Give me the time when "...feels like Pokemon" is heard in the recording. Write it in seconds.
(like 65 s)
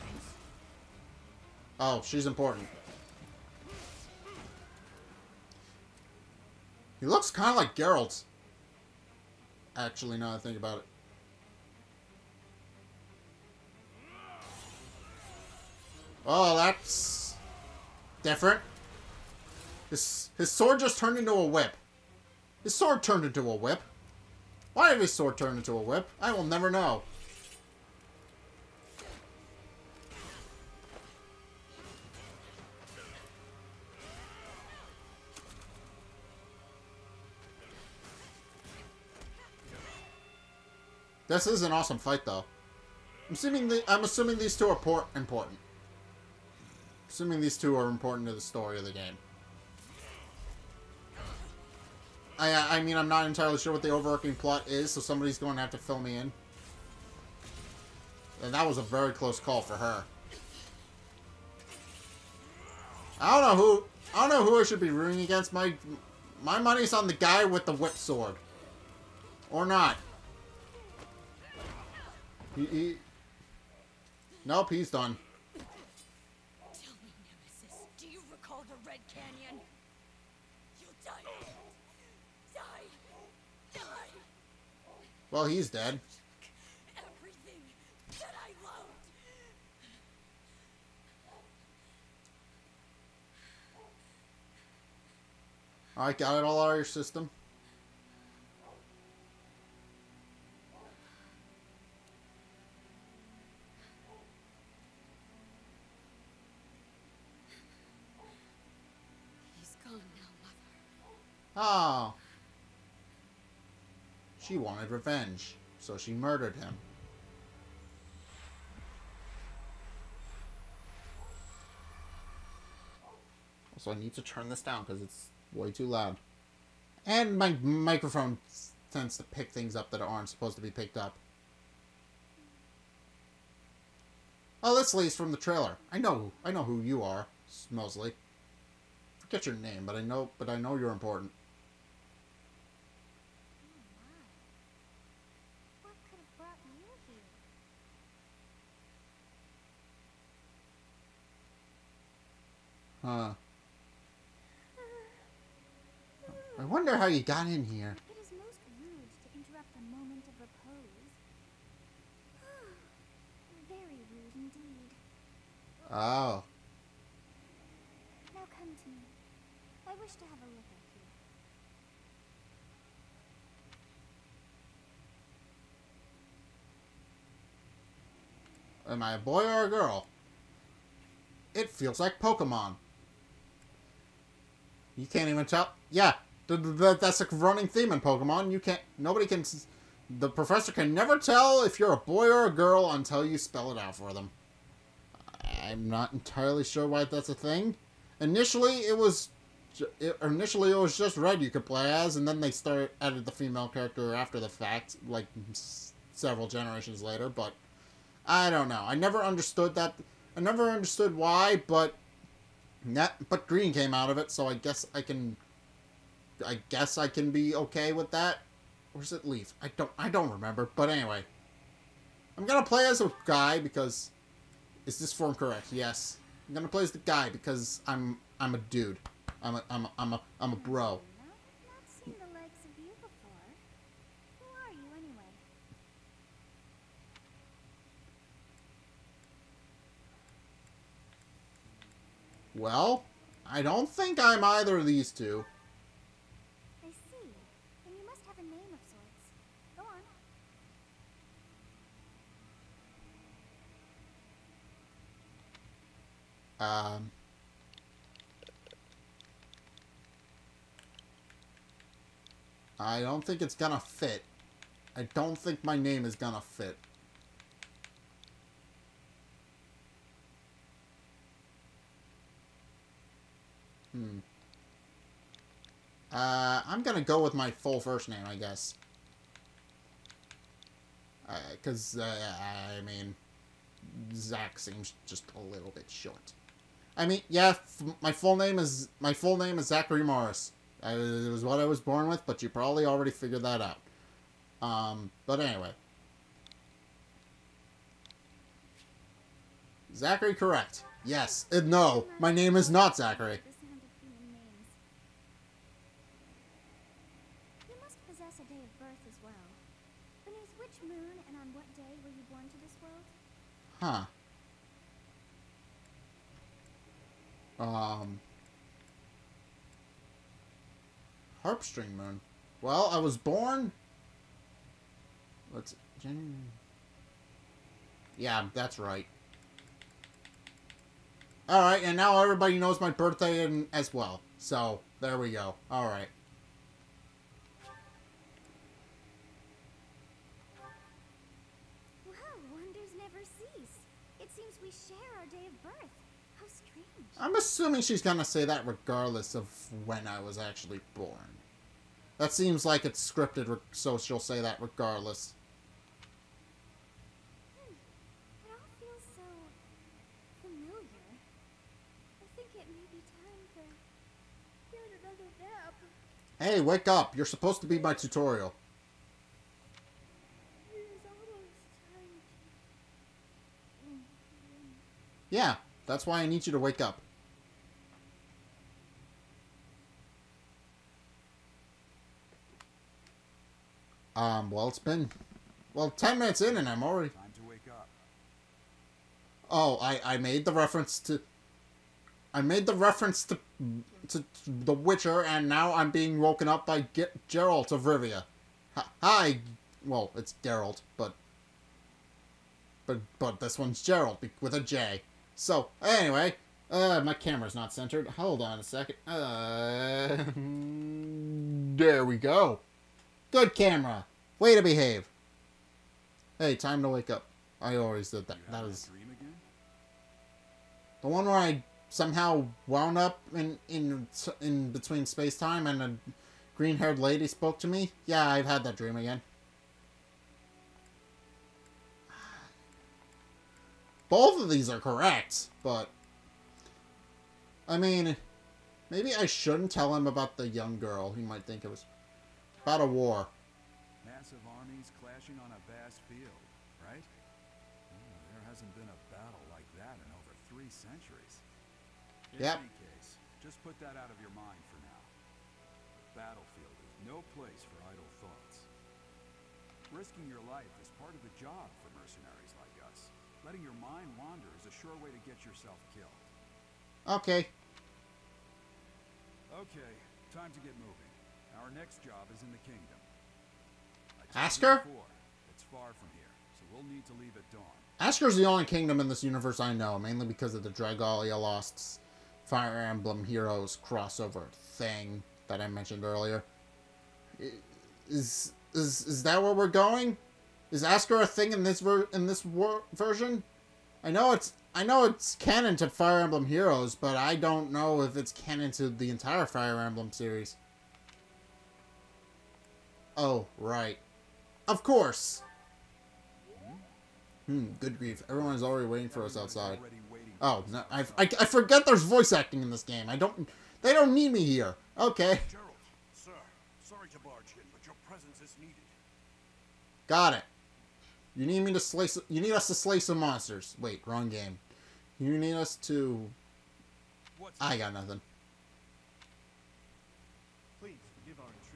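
181 s.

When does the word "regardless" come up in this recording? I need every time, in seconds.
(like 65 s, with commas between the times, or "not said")
348 s, 354 s.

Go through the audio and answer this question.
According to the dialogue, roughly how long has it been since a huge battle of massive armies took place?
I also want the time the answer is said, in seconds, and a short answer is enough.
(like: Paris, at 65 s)
over three centuries, at 450 s.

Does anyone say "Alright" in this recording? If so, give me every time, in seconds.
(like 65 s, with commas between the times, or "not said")
331 s, 335 s.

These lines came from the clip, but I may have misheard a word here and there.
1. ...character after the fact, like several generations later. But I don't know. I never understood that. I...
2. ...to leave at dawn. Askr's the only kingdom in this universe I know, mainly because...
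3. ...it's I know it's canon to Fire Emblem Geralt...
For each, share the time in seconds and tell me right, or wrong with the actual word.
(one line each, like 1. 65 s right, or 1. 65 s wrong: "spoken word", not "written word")
1. 203 s right
2. 477 s right
3. 494 s wrong: "Heroes", not "Geralt".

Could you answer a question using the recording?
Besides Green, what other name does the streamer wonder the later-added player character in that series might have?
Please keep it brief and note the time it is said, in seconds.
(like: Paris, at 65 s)
Leaf, at 218 s.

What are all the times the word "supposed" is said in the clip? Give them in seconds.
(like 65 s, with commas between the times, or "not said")
130 s, 367 s.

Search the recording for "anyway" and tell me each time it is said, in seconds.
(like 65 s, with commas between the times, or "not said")
220 s, 295 s, 405 s.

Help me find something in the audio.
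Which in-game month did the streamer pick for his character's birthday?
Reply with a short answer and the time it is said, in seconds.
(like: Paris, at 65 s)
Harpstring Moon, at 321 s.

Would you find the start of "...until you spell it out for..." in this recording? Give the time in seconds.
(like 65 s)
192 s.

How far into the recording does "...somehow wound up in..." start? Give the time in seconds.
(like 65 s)
421 s.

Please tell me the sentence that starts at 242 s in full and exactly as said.
Well, I don't think I'm either of these two.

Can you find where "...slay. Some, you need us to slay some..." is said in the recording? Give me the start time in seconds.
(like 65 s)
521 s.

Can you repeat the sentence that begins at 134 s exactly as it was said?
Oh, this lady's from the trailer.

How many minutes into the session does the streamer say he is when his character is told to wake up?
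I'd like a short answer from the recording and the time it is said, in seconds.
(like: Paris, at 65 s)
10, at 384 s.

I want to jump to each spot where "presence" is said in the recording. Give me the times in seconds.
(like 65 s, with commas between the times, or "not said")
518 s.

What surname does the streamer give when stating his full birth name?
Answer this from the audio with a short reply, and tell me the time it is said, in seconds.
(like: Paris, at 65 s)
Morris, at 288 s.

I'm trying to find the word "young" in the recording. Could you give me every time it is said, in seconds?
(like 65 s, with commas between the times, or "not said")
440 s.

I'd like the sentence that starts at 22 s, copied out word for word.
His sword turned into a whip.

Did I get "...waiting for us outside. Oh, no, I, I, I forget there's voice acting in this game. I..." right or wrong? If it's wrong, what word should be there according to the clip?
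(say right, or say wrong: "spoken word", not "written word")
right.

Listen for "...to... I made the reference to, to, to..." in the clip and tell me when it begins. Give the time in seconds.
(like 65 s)
391 s.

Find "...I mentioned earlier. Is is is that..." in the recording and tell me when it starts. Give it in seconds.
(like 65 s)
485 s.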